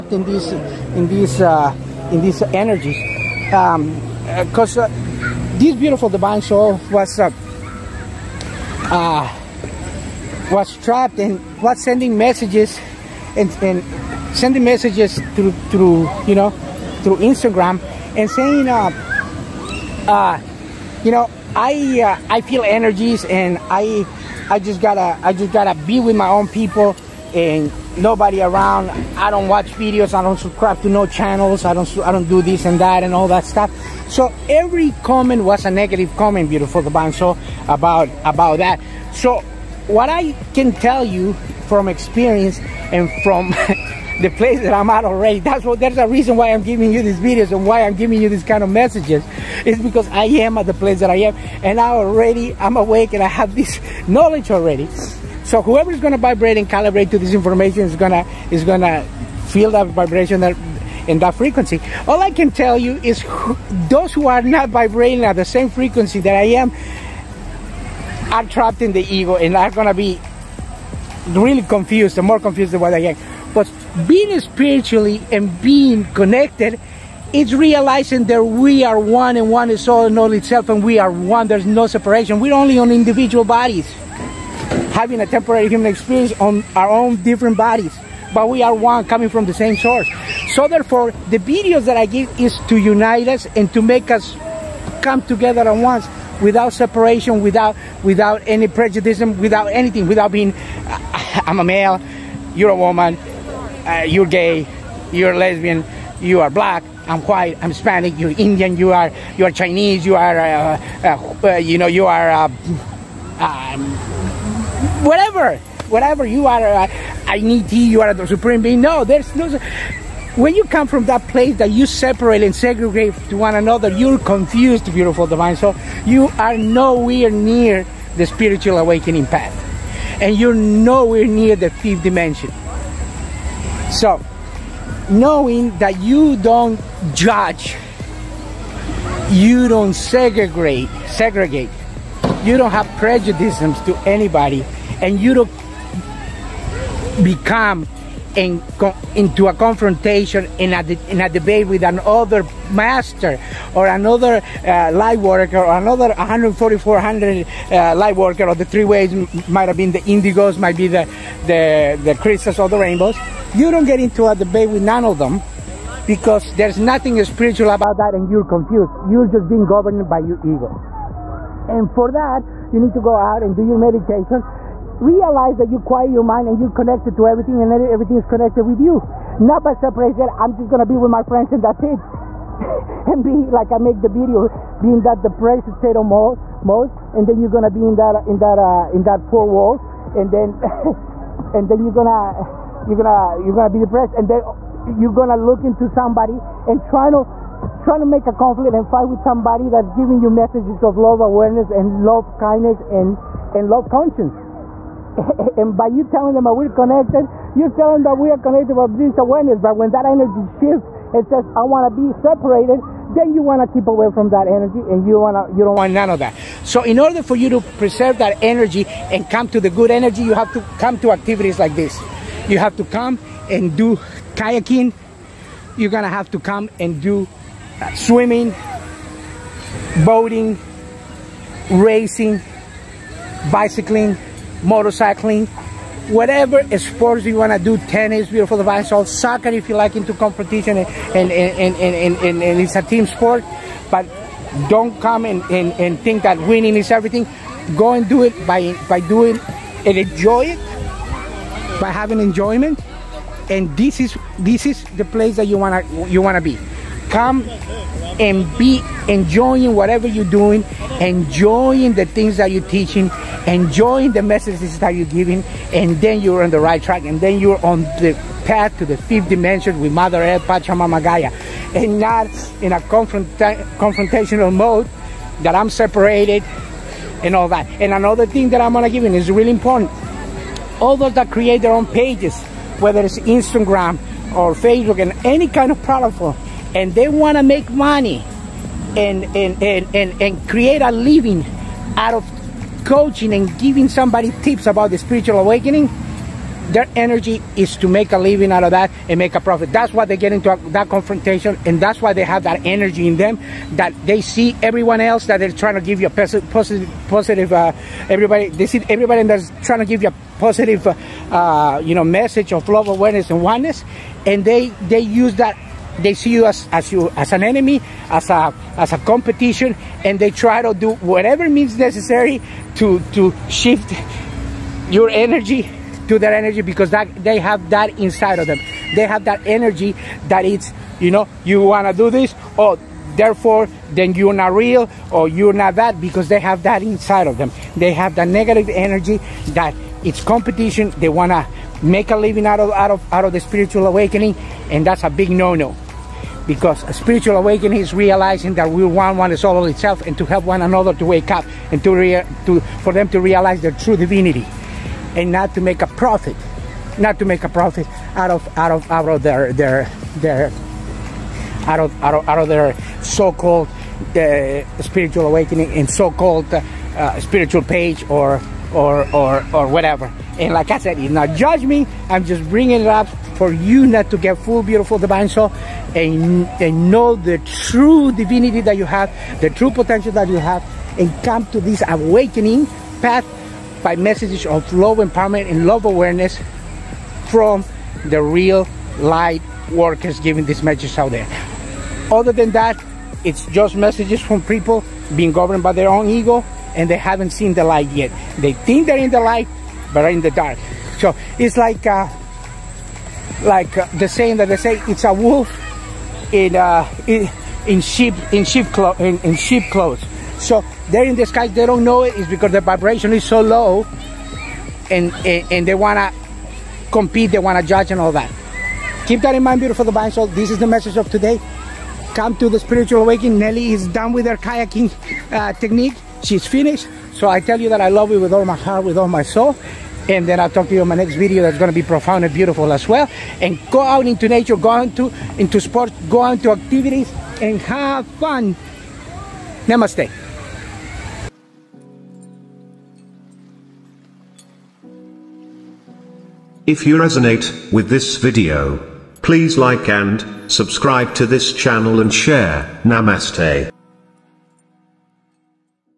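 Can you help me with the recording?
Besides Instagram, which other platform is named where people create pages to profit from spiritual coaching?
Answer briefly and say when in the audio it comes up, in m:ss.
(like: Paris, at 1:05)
Facebook, at 4:44.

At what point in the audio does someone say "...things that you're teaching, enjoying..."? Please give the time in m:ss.
4:22.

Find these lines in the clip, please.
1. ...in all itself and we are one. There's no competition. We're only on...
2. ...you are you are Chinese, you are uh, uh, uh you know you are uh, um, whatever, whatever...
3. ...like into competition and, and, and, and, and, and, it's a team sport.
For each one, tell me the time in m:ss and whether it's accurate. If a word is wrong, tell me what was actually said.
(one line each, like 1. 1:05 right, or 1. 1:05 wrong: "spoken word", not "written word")
1. 1:20 wrong: "separation", not "competition"
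2. 1:48 right
3. 3:59 right.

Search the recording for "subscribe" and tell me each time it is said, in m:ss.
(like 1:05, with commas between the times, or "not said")
0:30, 7:30.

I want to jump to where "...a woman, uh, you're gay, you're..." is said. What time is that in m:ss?
1:42.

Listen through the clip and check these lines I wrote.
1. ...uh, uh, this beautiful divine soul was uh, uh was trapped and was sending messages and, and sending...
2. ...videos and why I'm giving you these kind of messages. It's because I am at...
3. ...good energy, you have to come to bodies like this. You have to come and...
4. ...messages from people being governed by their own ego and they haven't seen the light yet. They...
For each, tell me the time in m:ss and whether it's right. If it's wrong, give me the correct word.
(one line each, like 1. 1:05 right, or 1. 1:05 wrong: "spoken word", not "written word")
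1. 0:04 right
2. 0:47 right
3. 3:39 wrong: "activities", not "bodies"
4. 6:33 right.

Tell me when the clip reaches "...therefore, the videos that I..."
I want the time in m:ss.
1:30.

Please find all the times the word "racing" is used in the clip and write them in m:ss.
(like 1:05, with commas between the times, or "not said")
3:51.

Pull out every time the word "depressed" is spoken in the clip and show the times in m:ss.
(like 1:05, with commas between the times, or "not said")
3:05, 3:13.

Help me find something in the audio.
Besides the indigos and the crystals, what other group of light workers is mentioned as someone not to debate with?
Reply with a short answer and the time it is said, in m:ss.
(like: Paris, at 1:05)
rainbows, at 2:42.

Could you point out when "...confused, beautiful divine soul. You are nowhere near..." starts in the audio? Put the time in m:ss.
2:04.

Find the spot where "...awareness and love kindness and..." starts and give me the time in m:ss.
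3:21.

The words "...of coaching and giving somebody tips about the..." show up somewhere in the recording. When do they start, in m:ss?
4:52.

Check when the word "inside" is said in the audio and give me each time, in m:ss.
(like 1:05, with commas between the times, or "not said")
5:27, 5:36.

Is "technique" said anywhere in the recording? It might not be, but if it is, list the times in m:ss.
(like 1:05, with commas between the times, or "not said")
7:05.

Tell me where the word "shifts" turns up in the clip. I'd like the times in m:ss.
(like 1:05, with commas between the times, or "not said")
3:30, 5:23.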